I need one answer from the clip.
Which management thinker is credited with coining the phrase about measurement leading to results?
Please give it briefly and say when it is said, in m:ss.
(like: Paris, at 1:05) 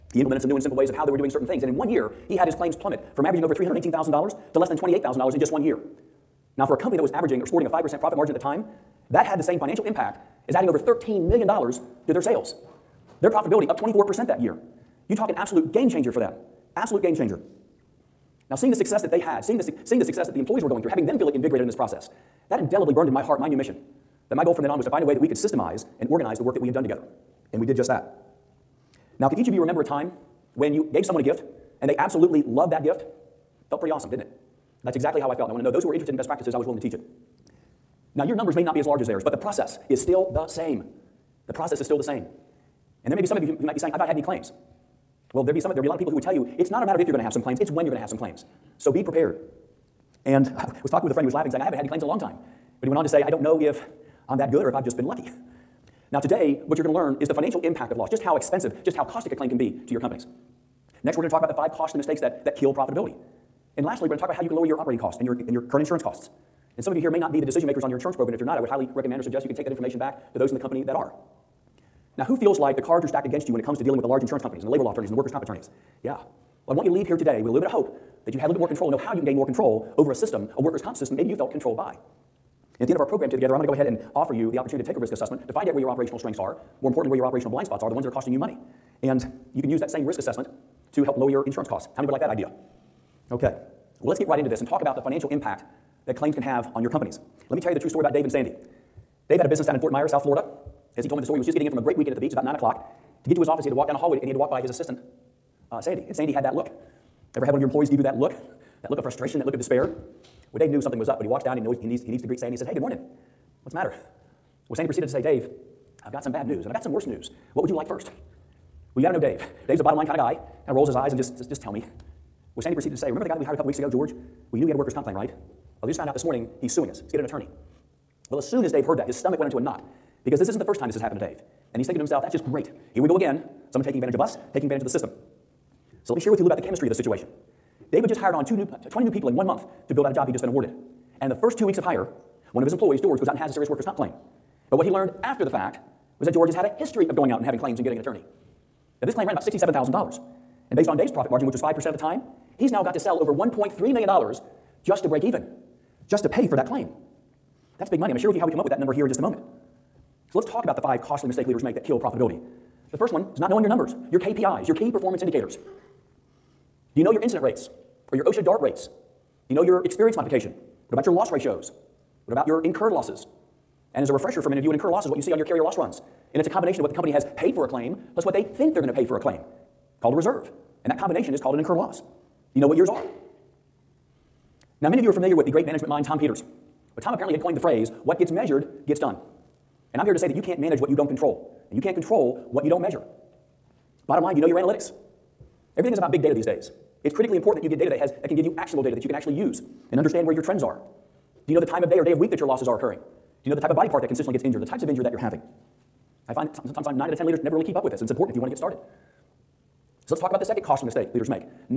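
Tom Peters, at 3:06.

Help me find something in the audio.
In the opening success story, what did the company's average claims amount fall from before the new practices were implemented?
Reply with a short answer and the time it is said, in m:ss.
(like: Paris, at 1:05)
$318,000, at 0:03.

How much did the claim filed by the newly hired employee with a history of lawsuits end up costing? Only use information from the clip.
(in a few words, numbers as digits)
$67,000.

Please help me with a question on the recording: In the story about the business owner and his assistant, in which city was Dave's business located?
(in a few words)
Fort Myers.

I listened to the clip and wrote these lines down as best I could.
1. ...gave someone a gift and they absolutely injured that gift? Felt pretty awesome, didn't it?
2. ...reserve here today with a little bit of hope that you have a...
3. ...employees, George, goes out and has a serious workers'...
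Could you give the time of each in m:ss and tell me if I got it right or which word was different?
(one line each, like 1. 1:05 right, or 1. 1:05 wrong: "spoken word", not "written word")
1. 0:30 wrong: "loved", not "injured"
2. 1:16 wrong: "leave", not "reserve"
3. 2:22 right.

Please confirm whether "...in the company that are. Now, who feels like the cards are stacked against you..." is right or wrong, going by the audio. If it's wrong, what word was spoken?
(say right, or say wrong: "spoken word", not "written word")
right.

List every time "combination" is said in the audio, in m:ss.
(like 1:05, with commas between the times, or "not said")
2:56, 3:00.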